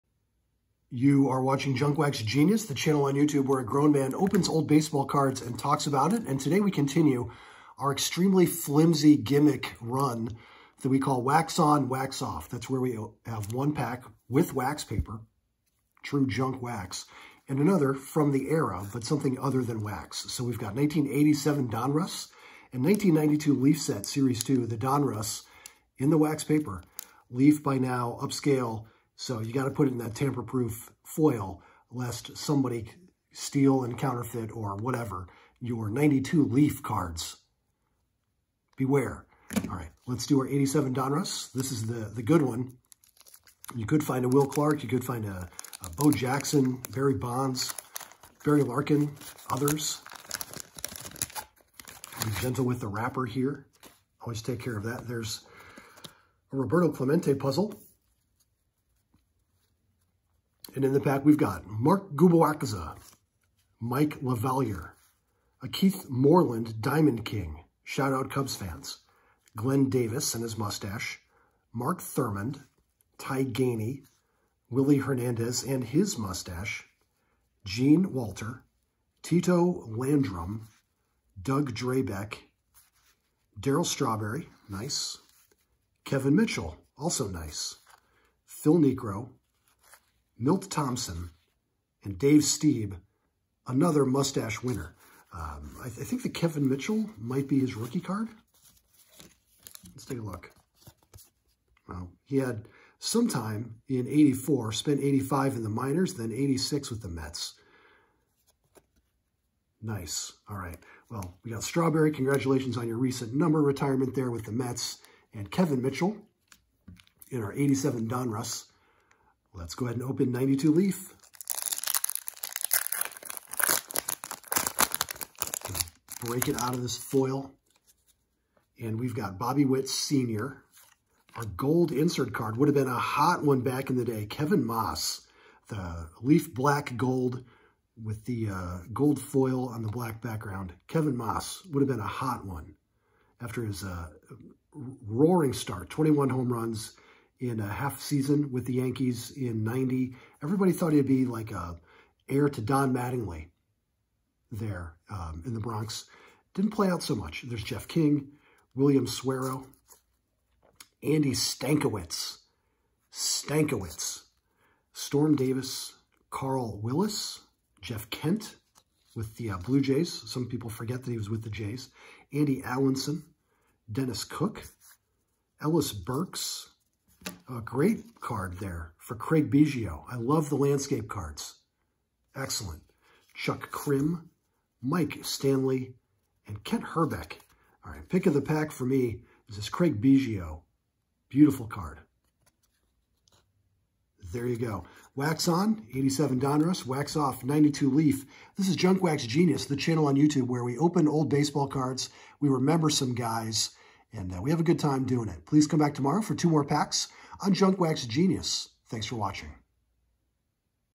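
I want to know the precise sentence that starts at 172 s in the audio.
Andy Allanson, Dennis Cook, Ellis Burks, a great card there for Craig Biggio.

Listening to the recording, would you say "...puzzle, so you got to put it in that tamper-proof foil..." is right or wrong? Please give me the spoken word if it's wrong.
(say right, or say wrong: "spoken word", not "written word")
wrong: "upscale", not "puzzle".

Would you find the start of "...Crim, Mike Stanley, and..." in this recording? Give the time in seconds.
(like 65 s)
183 s.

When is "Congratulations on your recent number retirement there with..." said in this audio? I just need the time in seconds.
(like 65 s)
112 s.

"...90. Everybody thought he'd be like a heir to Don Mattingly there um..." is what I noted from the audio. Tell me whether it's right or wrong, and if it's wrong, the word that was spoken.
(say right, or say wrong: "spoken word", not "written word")
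right.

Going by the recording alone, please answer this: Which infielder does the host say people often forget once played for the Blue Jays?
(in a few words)
Jeff Kent.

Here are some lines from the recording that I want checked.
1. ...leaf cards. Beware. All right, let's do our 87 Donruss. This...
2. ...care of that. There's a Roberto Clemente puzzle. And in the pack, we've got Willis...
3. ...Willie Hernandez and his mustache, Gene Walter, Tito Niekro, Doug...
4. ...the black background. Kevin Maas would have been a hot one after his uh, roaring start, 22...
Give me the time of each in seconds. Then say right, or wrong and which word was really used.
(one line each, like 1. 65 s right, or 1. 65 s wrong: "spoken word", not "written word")
1. 36 s right
2. 54 s wrong: "Mark", not "Willis"
3. 74 s wrong: "Landrum", not "Niekro"
4. 139 s wrong: "21", not "22".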